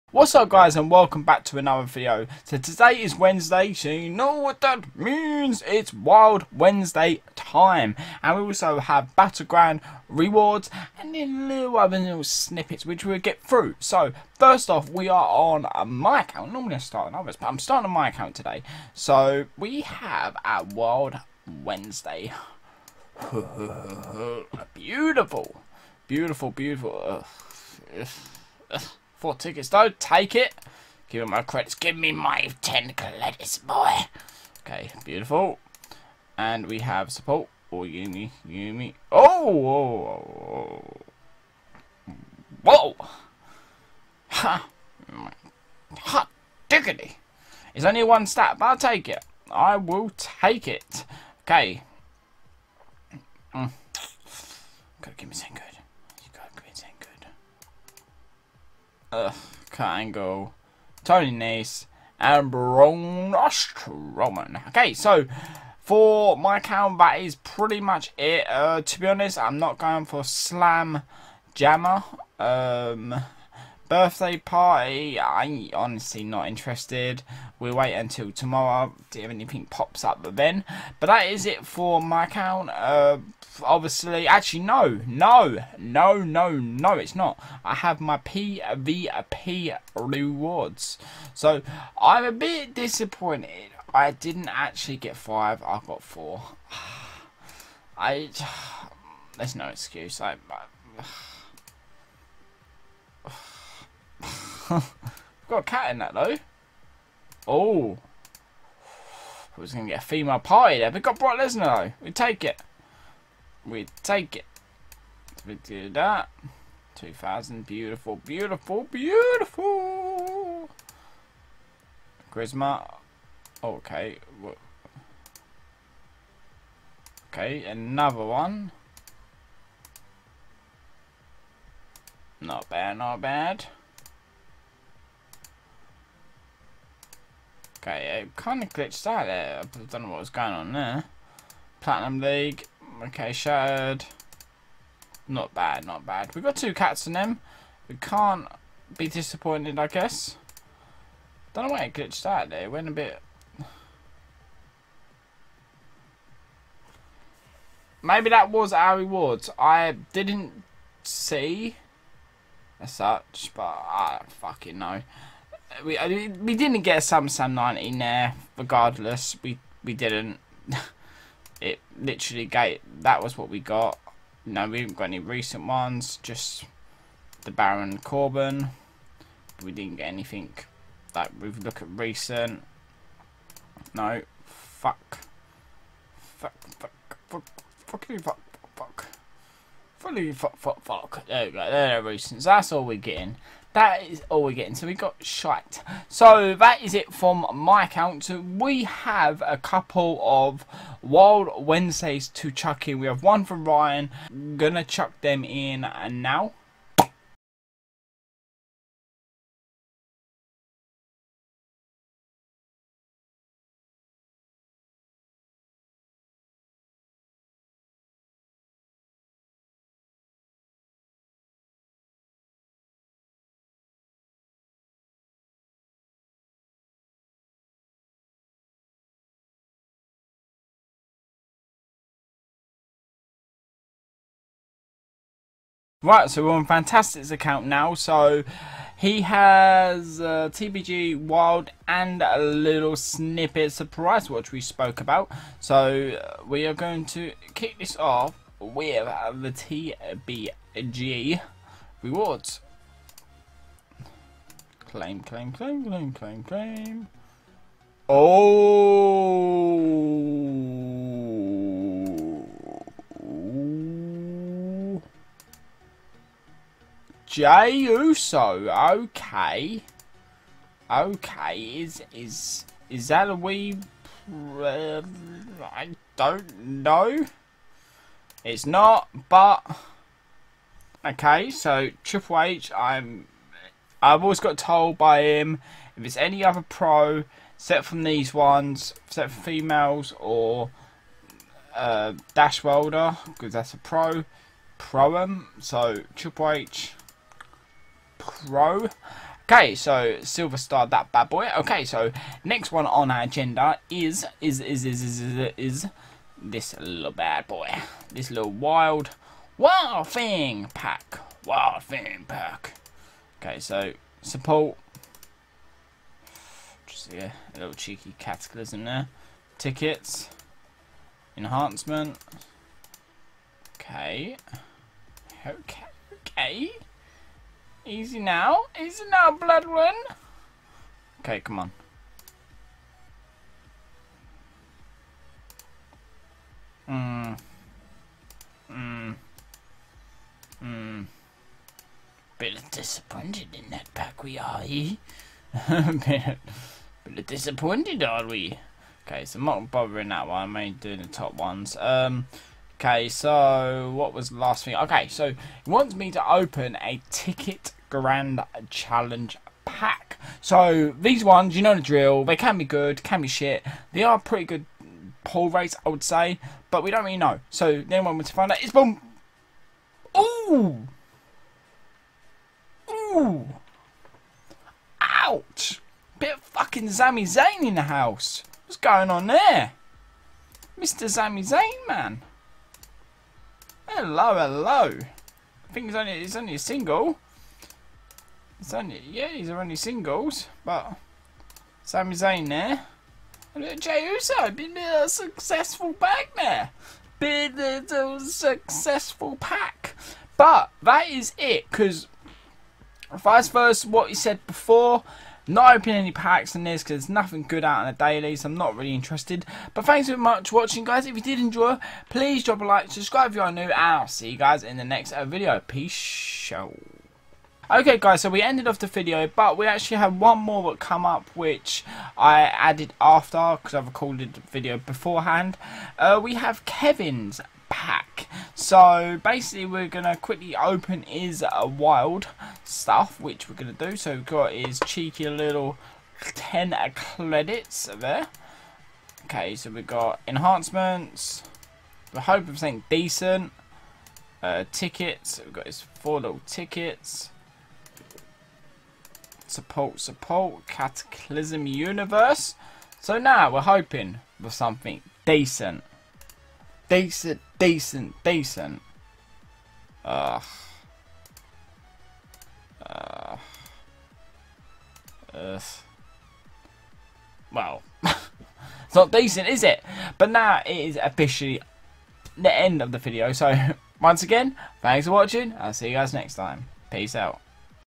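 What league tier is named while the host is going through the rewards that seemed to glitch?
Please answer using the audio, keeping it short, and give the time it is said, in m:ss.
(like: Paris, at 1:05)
Platinum League, at 2:21.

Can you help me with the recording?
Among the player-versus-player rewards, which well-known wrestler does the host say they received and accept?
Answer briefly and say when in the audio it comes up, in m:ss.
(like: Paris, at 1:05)
Brock Lesnar, at 1:51.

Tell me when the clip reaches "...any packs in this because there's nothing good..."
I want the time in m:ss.
6:45.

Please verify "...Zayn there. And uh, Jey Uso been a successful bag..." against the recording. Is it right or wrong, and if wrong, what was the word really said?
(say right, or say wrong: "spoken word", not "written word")
right.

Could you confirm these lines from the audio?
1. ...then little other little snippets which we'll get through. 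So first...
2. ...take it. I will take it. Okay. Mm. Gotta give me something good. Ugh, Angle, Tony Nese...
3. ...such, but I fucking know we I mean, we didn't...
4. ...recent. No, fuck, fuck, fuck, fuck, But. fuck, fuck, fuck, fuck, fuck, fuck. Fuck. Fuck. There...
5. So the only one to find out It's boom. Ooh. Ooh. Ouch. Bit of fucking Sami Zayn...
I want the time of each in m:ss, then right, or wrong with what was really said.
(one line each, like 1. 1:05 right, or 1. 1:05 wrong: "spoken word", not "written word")
1. 0:11 right
2. 0:48 right
3. 2:42 right
4. 3:01 wrong: "Fuck", not "But"
5. 6:07 right.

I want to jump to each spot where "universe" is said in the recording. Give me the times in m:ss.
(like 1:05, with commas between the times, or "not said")
7:31.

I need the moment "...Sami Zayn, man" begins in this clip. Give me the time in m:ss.
6:21.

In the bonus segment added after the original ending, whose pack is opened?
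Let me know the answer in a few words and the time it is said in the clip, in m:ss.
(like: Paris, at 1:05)
Kevin, at 7:06.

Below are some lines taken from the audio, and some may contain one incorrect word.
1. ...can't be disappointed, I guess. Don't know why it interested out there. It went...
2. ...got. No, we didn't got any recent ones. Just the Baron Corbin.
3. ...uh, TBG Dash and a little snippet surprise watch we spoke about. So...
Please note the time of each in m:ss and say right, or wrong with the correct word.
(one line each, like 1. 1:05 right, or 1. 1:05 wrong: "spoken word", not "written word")
1. 2:27 wrong: "glitched", not "interested"
2. 2:53 right
3. 4:00 wrong: "Wild", not "Dash".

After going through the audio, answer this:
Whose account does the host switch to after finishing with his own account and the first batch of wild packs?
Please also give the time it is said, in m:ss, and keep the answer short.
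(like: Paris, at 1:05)
Fantastic, at 3:56.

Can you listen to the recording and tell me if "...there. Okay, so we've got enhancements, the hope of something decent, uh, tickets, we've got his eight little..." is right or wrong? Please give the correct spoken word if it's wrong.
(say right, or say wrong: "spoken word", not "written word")
wrong: "four", not "eight".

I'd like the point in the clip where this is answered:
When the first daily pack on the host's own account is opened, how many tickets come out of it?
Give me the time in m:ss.
0:29.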